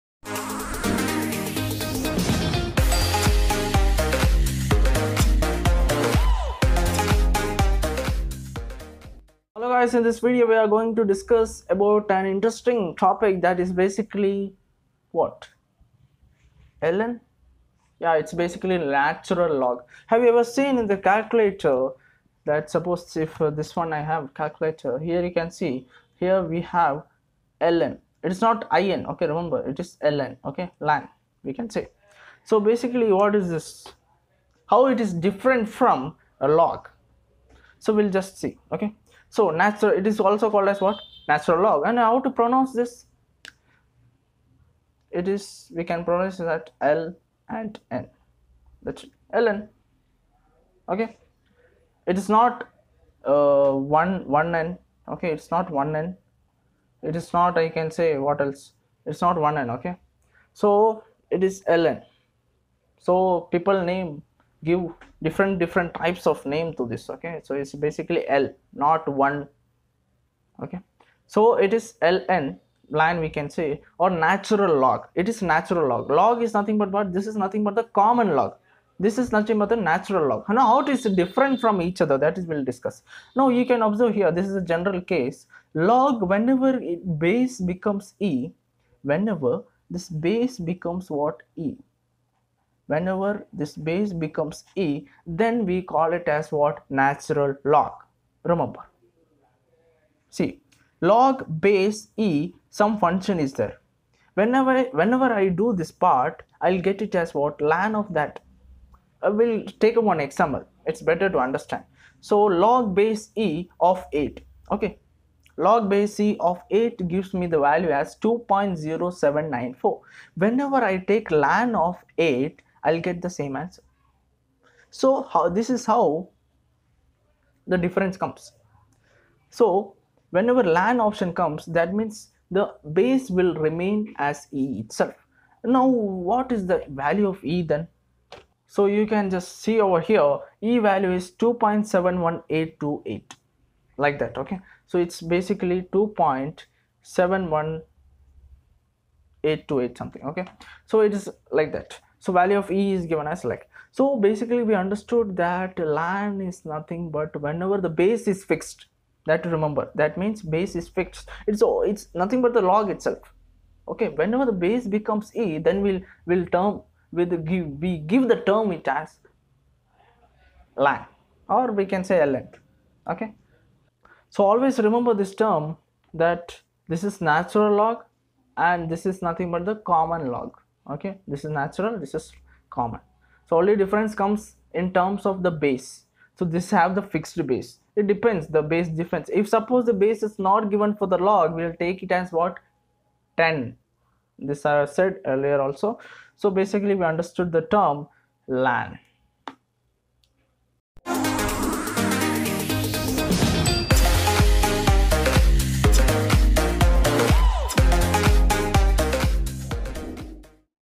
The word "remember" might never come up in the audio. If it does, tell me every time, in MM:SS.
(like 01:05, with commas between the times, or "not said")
00:29, 01:38, 02:39, 02:54.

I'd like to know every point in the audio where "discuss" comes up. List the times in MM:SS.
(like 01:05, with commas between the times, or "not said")
00:11, 01:22.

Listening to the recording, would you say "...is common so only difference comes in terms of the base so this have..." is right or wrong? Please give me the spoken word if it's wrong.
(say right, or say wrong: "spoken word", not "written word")
right.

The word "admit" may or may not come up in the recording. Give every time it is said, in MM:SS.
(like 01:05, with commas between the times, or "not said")
not said.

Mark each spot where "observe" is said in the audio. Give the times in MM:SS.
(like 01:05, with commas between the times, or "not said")
01:23.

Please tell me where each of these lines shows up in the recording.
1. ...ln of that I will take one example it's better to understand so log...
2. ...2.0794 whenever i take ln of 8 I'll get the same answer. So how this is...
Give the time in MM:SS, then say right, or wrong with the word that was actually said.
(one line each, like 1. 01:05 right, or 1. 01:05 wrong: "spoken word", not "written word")
1. 01:47 right
2. 01:58 right.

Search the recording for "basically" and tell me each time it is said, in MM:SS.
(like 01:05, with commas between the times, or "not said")
00:13, 00:18, 00:32, 01:07, 02:25, 02:34, 03:16.